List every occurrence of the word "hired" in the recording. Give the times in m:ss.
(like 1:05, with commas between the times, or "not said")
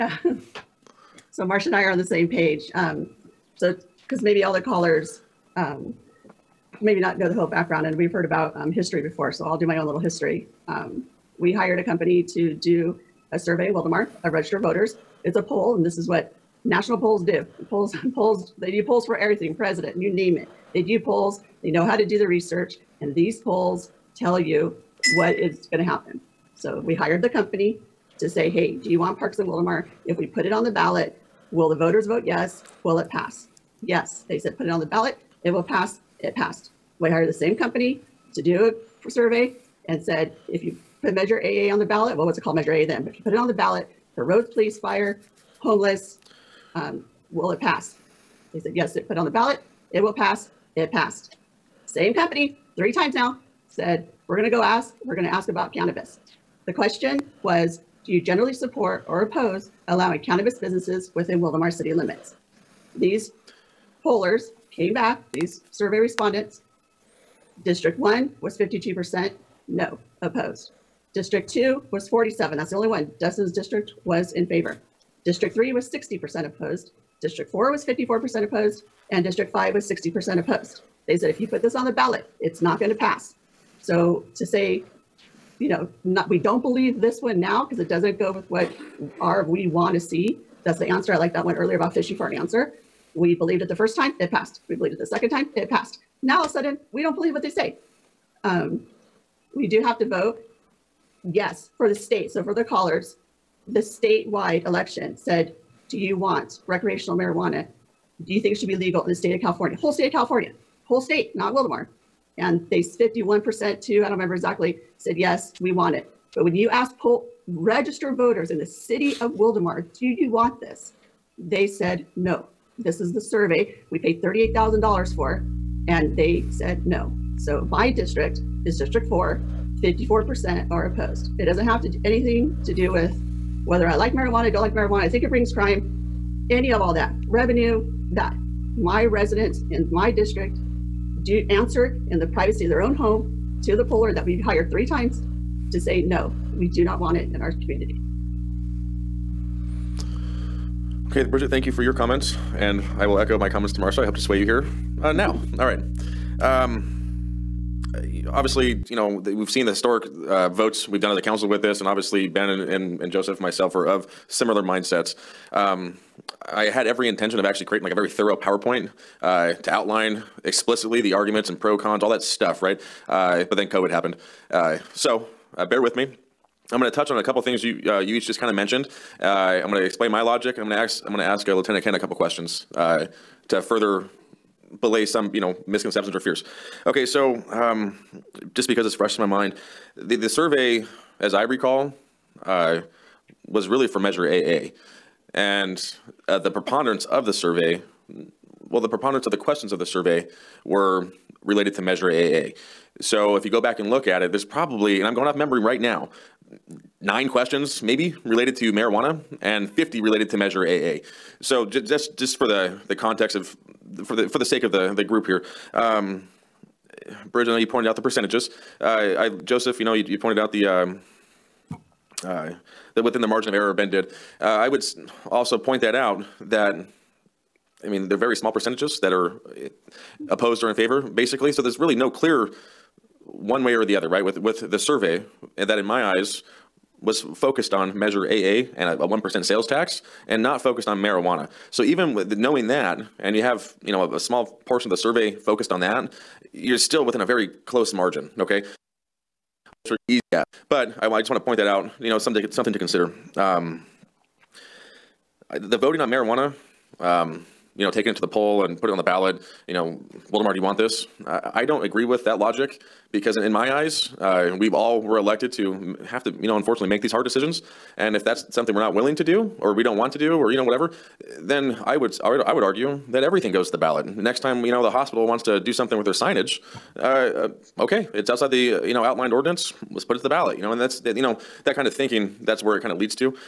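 0:11, 0:26, 0:37, 2:24.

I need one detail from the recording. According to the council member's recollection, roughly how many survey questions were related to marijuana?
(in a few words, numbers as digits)
9.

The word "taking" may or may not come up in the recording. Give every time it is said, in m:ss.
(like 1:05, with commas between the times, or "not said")
4:17.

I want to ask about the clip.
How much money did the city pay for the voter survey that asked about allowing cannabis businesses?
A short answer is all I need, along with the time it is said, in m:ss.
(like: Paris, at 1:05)
$38,000, at 2:04.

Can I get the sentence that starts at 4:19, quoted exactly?
You know, Wildomar, do you want this?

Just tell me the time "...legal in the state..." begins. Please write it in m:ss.
1:48.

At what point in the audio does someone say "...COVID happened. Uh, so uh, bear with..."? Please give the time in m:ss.
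2:53.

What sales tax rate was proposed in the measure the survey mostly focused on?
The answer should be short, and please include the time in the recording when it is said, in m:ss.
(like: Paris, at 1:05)
1 percent, at 3:59.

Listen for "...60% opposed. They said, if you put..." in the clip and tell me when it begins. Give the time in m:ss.
1:19.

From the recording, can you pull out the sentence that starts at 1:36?
Now all of a sudden, we don't believe what they say.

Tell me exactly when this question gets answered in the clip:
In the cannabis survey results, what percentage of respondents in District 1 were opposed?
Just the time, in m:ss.
1:08.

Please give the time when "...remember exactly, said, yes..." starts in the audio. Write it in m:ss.
1:54.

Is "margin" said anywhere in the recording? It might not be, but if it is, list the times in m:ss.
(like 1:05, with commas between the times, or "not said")
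3:43, 4:07.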